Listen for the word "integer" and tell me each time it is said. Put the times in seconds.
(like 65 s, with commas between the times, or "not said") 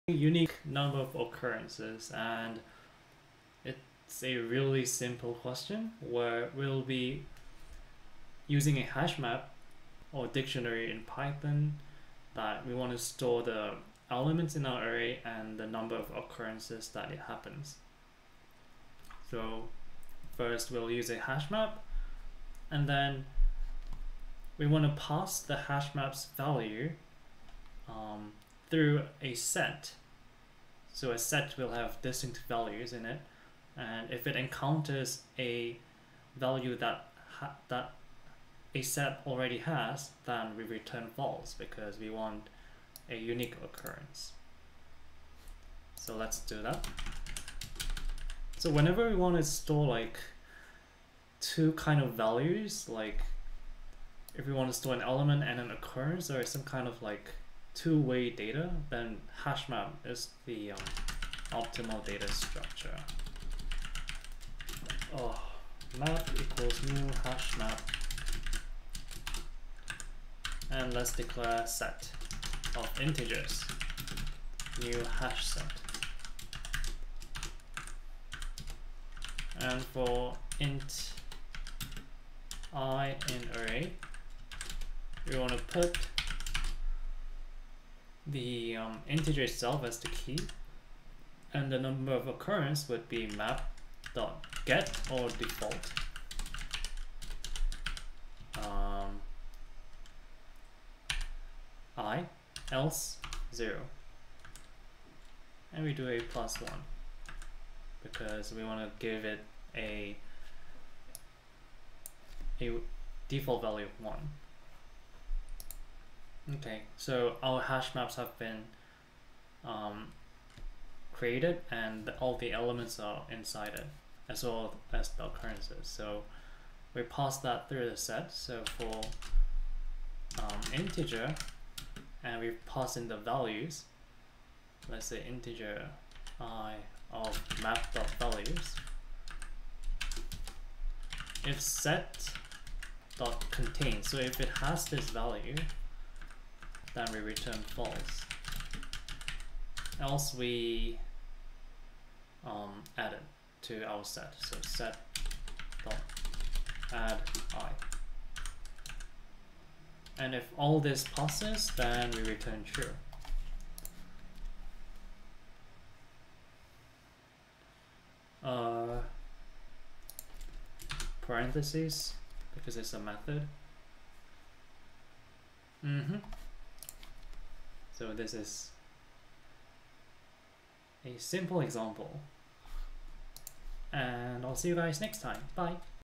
73 s, 89 s, 130 s, 135 s.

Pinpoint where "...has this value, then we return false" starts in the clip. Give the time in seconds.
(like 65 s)
144 s.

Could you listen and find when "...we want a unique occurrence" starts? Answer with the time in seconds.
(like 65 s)
41 s.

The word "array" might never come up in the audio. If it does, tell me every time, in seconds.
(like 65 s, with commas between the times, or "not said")
14 s, 83 s.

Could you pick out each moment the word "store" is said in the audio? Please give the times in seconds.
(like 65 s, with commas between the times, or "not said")
12 s, 49 s, 54 s.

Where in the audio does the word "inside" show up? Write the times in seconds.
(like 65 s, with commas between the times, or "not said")
123 s.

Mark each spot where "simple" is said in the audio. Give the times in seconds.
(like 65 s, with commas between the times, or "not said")
4 s, 181 s.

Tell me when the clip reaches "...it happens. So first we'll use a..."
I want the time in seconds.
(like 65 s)
17 s.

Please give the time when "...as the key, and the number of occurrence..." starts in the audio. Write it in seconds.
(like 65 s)
89 s.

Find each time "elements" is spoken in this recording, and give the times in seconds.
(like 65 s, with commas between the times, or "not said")
14 s, 55 s, 122 s.